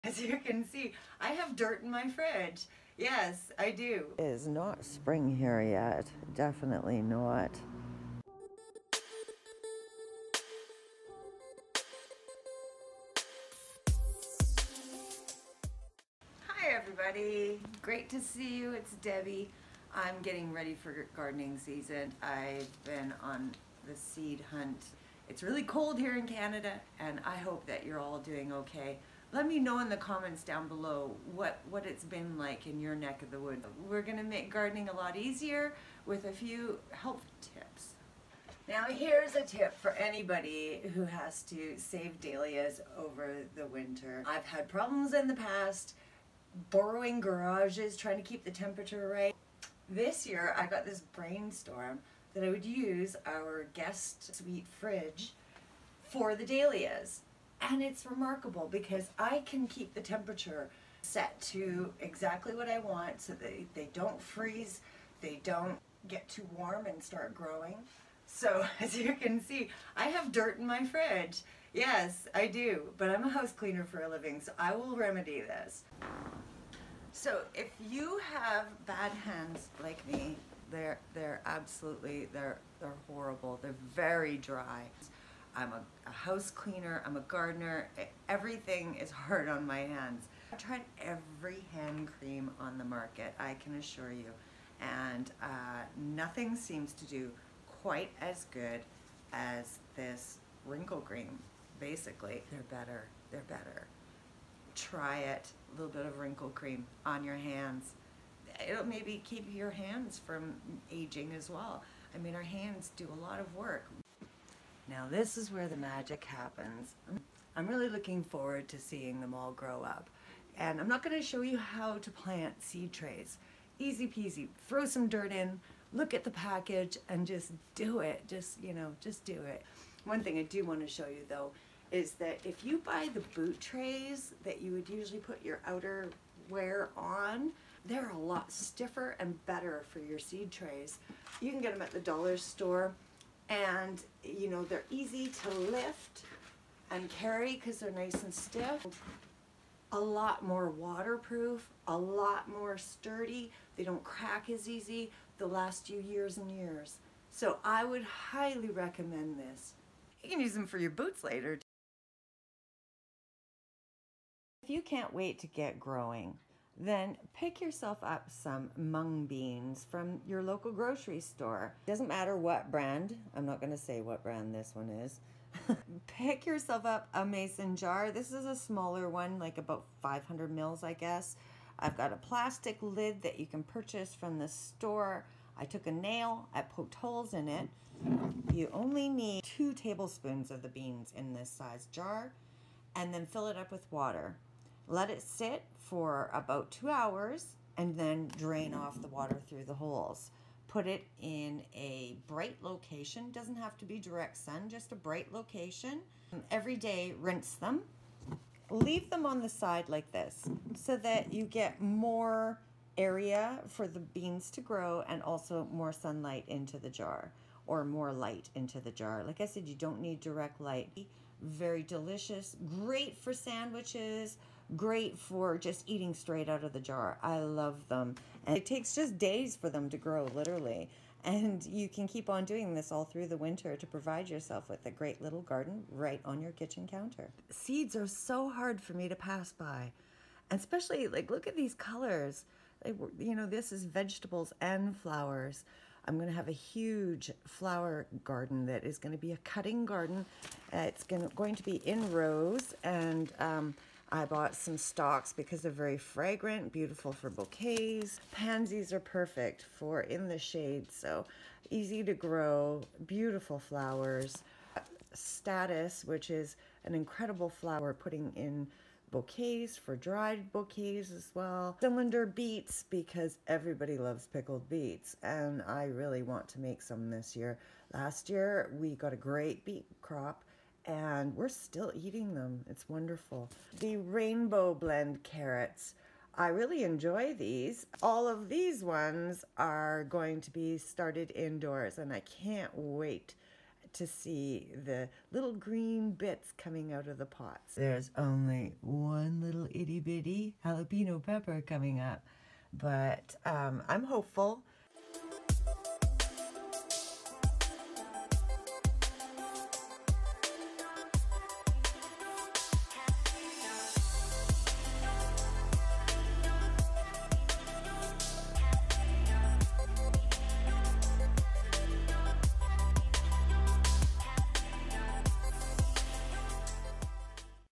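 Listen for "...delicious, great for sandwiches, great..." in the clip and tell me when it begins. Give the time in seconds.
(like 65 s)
221 s.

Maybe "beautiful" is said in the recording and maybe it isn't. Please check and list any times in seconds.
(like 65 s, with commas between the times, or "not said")
256 s, 263 s.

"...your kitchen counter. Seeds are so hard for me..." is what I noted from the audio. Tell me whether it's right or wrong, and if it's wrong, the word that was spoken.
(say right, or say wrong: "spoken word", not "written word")
right.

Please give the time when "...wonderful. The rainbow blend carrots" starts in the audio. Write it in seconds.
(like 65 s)
282 s.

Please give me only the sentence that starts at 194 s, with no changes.
Let it sit for about two hours and then drain off the water through the holes.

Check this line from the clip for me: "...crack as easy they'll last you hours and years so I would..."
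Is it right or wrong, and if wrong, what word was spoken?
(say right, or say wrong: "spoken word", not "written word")
wrong: "years", not "hours".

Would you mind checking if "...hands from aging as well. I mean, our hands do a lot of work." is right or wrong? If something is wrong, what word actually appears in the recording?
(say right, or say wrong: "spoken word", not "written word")
right.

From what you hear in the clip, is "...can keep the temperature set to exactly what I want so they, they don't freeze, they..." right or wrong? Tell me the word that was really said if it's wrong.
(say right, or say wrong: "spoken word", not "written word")
right.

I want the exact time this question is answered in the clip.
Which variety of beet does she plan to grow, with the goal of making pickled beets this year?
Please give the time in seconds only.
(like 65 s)
271 s.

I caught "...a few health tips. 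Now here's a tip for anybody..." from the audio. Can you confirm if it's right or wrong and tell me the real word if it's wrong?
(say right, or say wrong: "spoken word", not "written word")
right.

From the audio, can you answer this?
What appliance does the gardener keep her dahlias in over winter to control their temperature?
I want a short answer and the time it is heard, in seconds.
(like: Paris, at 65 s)
guest suite fridge, at 53 s.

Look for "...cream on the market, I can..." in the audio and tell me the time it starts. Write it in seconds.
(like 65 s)
92 s.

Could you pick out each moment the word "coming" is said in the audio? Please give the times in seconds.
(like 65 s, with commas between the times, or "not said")
296 s, 301 s.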